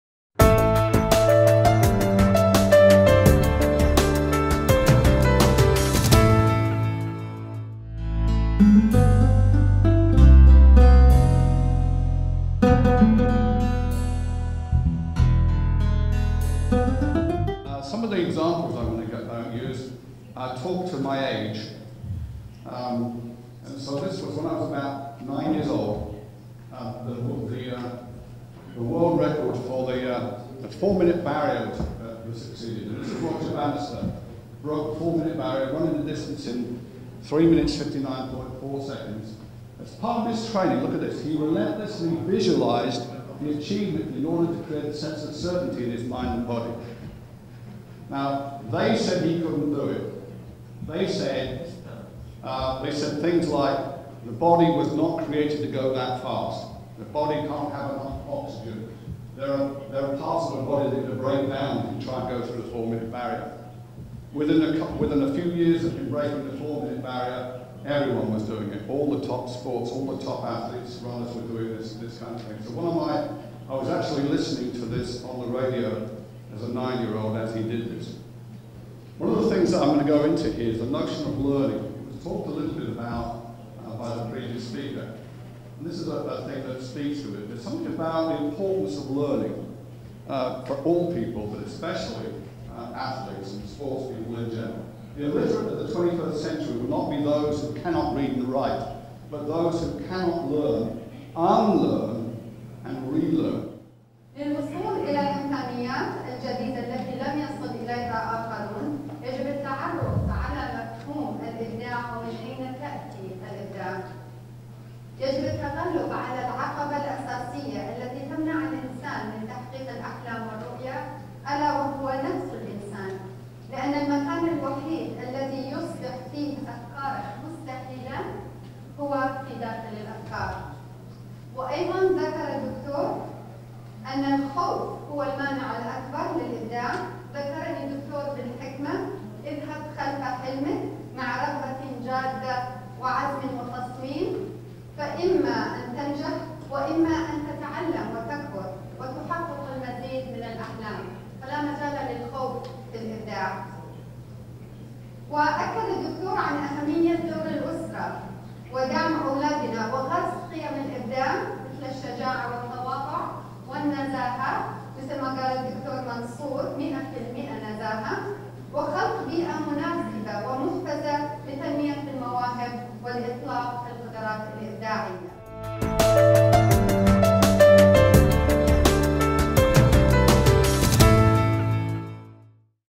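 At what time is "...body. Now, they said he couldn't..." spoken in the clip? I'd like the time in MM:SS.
00:46.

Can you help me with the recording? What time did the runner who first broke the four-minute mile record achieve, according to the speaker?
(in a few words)
3 minutes 59.4 seconds.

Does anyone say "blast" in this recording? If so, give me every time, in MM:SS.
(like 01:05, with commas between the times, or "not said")
not said.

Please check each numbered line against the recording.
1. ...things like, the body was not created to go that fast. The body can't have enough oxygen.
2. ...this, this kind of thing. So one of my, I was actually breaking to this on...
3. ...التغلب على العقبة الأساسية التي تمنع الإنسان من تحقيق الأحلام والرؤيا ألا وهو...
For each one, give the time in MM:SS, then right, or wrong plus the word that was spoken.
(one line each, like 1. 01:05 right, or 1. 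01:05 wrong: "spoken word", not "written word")
1. 00:53 right
2. 01:11 wrong: "listening", not "breaking"
3. 01:55 right.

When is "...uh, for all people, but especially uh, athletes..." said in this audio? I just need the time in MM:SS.
01:30.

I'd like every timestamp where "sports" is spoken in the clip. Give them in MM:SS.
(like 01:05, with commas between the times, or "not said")
01:09, 01:33.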